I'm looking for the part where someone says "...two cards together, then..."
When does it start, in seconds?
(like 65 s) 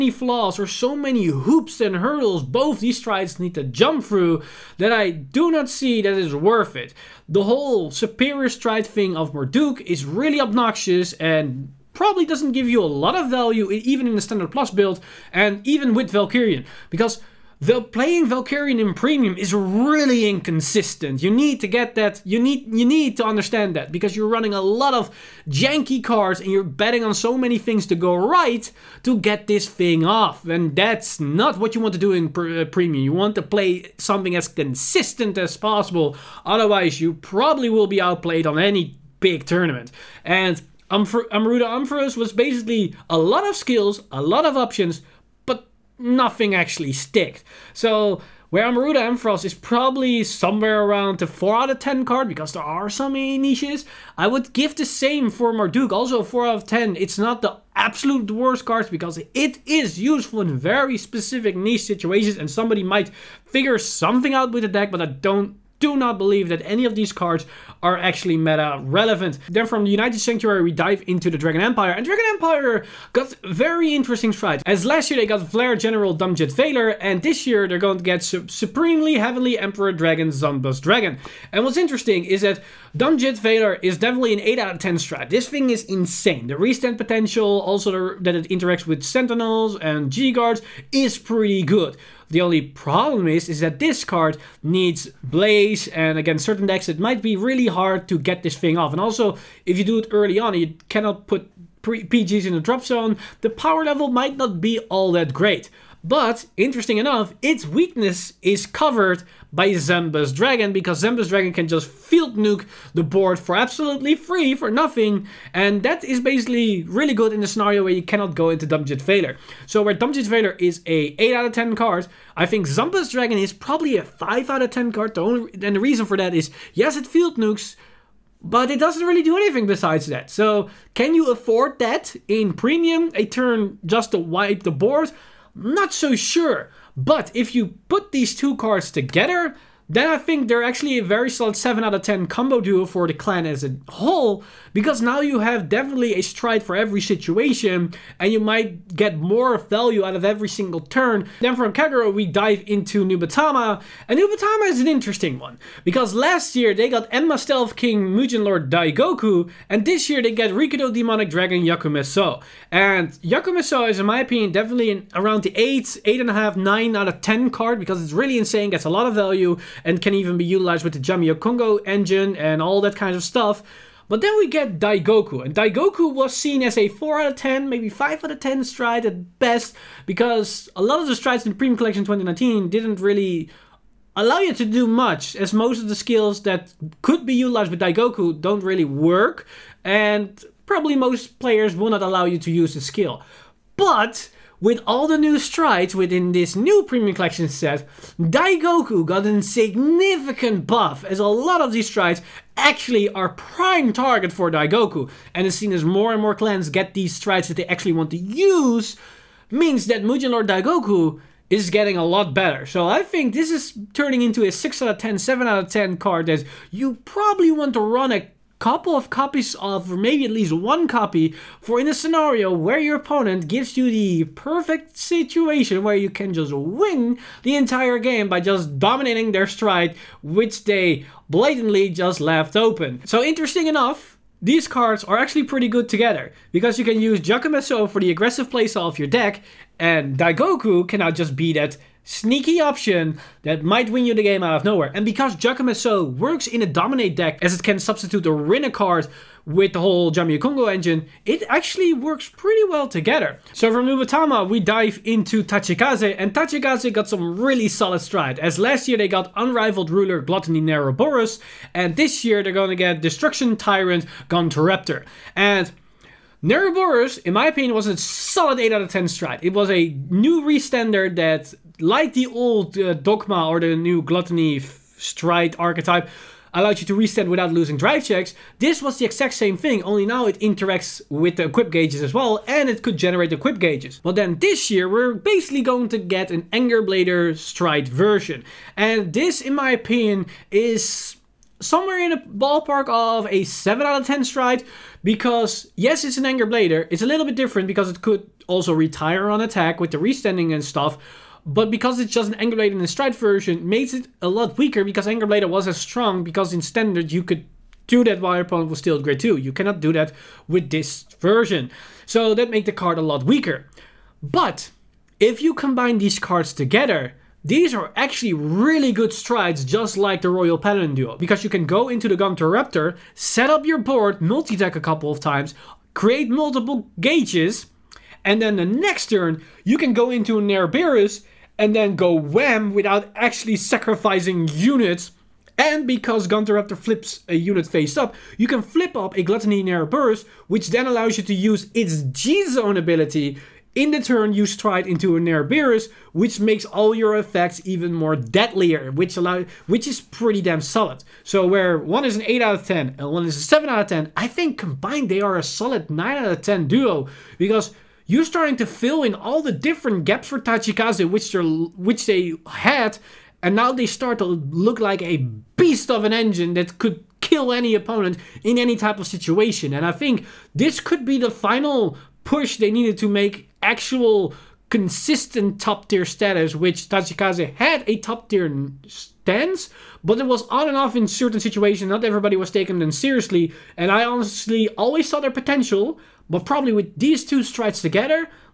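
138 s.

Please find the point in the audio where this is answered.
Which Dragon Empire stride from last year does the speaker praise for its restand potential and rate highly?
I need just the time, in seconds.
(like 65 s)
75 s.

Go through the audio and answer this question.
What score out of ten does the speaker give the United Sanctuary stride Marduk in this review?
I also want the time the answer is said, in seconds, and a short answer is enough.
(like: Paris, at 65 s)
4, at 55 s.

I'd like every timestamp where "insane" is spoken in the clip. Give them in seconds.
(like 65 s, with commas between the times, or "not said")
85 s, 168 s.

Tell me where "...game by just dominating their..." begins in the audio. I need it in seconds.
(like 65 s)
227 s.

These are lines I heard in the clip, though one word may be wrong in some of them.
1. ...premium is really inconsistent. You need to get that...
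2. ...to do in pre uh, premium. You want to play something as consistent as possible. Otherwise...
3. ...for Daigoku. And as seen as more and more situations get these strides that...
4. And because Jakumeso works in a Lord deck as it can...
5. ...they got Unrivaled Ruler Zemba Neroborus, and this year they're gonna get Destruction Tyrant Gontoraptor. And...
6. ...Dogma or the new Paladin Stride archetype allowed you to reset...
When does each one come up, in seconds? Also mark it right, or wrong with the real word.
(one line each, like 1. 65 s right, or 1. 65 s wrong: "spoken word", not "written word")
1. 18 s right
2. 31 s right
3. 204 s wrong: "clans", not "situations"
4. 244 s wrong: "Dominate", not "Lord"
5. 258 s wrong: "Gluttony", not "Zemba"
6. 272 s wrong: "Gluttony", not "Paladin".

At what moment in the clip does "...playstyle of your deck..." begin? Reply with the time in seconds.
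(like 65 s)
238 s.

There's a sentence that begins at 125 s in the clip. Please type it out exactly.
The only, and the reason for that is, yes, it field nukes, but it doesn't really do anything besides that.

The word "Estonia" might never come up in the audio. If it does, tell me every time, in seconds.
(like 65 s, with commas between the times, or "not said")
not said.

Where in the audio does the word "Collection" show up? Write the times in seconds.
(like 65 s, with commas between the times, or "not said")
181 s, 197 s.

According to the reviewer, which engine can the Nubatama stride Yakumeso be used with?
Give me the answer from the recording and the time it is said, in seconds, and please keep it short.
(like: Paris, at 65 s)
Jamio Kongo engine, at 170 s.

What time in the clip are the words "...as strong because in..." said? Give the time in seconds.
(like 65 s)
305 s.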